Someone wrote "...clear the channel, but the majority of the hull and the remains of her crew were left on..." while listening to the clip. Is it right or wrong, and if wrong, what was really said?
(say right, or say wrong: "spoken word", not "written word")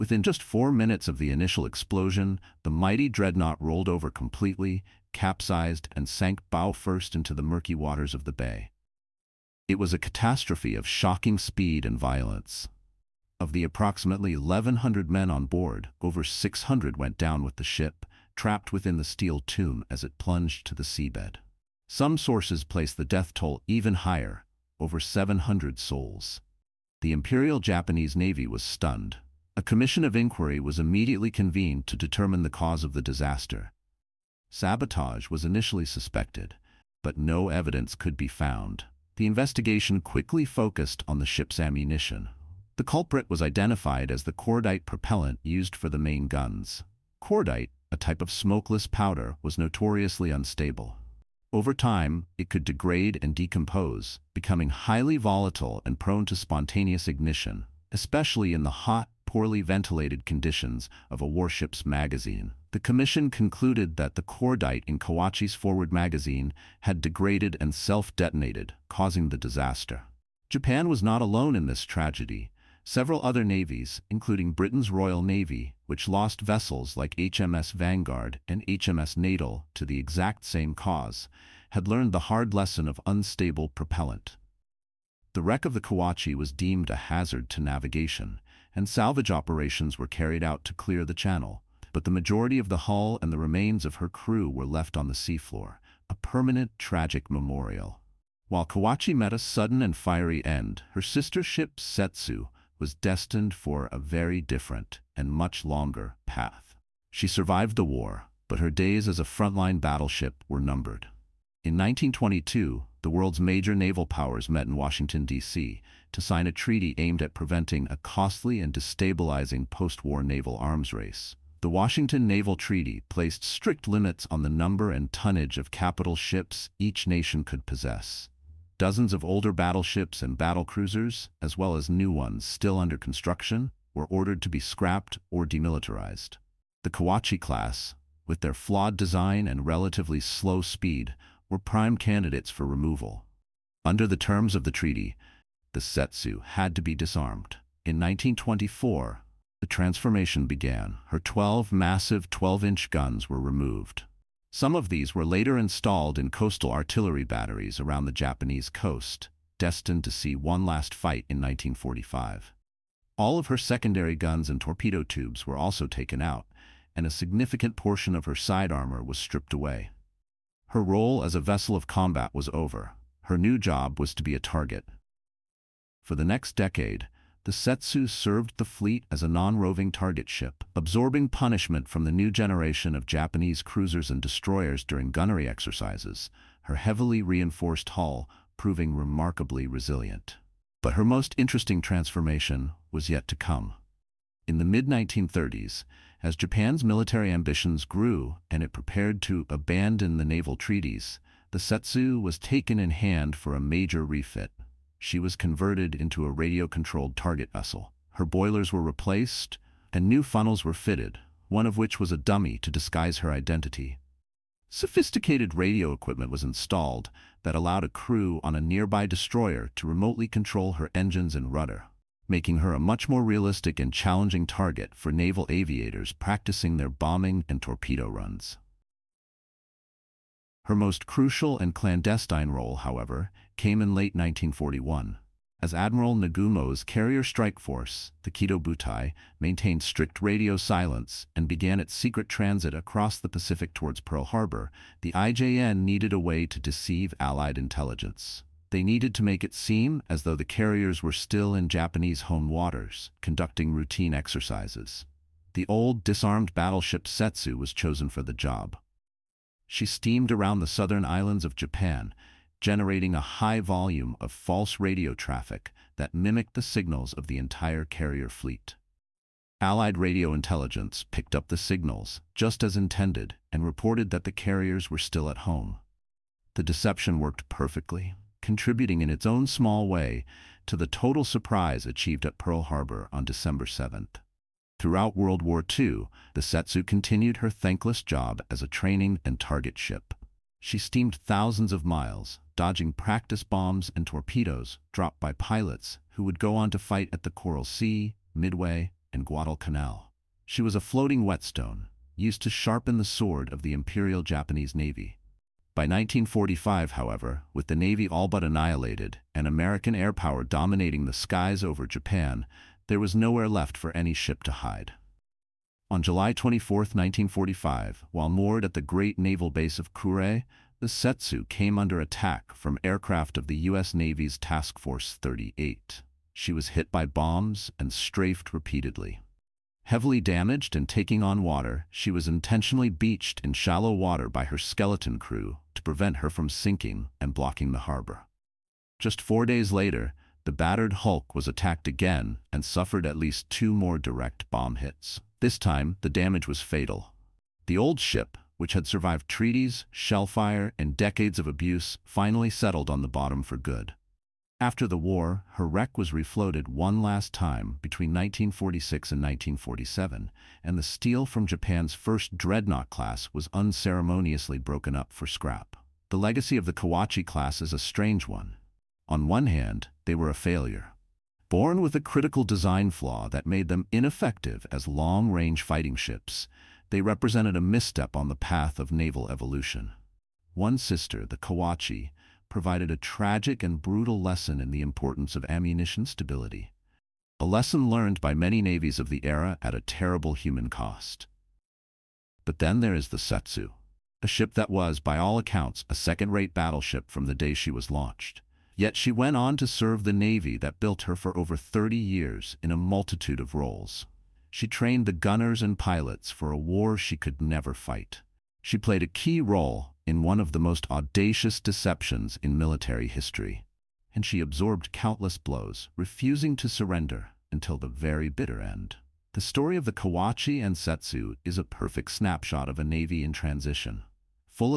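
right.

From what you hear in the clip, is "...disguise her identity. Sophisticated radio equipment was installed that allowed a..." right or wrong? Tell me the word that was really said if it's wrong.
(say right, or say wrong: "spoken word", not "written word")
right.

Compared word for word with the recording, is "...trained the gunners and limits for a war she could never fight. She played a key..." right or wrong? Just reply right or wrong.
wrong.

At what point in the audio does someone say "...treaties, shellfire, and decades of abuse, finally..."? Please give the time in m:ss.
5:49.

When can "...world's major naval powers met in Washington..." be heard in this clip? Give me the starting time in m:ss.
1:53.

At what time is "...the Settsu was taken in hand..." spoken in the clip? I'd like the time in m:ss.
3:21.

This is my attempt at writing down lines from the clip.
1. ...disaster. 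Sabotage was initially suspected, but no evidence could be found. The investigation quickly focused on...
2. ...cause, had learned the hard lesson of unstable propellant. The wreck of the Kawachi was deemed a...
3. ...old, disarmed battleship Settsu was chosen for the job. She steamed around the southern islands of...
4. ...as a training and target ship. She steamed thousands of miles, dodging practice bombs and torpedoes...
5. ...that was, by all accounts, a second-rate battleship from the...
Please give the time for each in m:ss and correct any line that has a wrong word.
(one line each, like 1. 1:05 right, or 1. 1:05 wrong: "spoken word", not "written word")
1. 0:33 right
2. 1:20 right
3. 4:15 right
4. 4:48 right
5. 6:34 right.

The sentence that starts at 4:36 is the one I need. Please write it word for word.
The deception worked perfectly contributing in its own small way to the total surprise achieved at Pearl Harbor on December 7th.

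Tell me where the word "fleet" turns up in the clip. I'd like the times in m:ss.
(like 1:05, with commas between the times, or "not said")
2:58, 4:28.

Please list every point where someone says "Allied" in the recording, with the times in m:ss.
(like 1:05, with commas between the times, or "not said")
4:07, 4:29.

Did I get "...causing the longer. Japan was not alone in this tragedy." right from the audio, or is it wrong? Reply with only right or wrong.
wrong.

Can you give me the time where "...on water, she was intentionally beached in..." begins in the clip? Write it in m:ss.
5:31.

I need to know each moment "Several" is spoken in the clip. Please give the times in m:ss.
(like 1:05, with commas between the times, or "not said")
1:12.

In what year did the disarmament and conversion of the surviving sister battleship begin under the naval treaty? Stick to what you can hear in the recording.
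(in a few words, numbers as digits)
1924.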